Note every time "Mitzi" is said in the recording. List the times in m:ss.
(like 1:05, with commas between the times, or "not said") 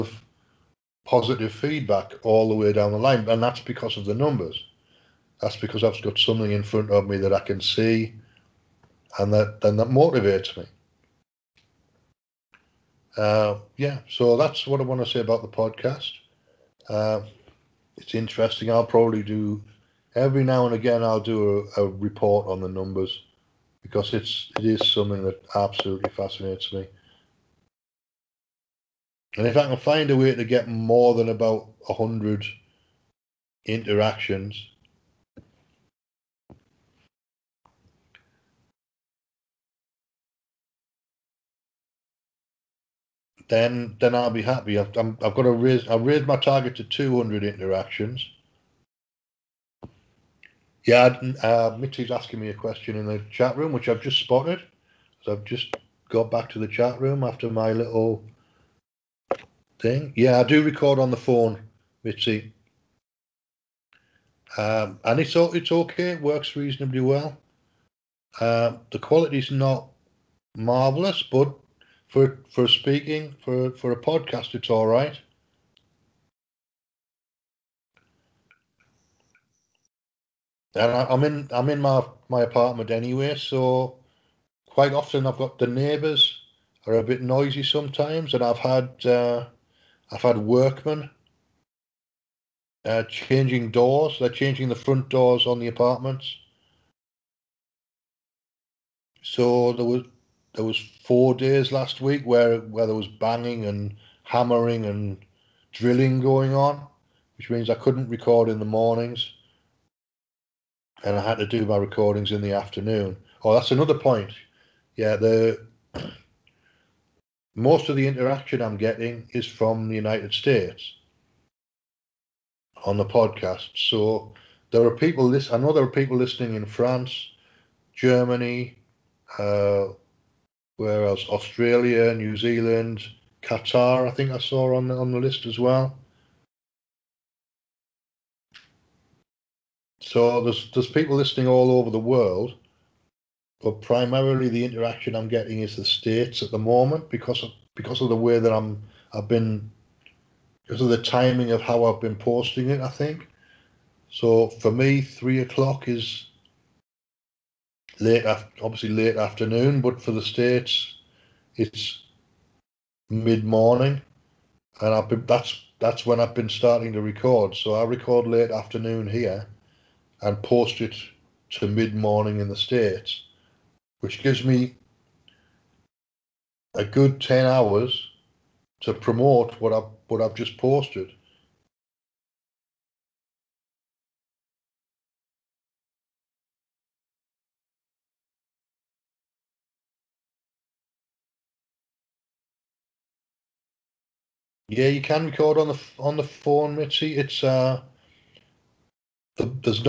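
0:51, 1:02, 3:16.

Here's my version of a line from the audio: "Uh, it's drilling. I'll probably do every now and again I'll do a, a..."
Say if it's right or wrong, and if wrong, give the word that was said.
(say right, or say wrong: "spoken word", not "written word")
wrong: "interesting", not "drilling".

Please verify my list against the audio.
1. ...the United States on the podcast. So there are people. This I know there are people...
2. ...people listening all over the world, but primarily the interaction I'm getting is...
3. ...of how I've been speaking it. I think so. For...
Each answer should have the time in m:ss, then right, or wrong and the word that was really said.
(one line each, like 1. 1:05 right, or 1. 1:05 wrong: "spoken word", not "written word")
1. 1:59 right
2. 2:20 right
3. 2:31 wrong: "posting", not "speaking".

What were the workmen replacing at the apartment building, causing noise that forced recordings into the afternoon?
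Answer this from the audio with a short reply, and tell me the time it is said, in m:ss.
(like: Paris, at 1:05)
Front doors, at 1:34.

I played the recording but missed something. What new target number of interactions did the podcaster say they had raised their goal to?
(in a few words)
200.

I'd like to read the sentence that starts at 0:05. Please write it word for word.
That's because I've got something in front of me that I can see, and that then that motivates me.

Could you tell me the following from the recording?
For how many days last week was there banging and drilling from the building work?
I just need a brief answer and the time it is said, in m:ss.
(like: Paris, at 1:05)
4, at 1:41.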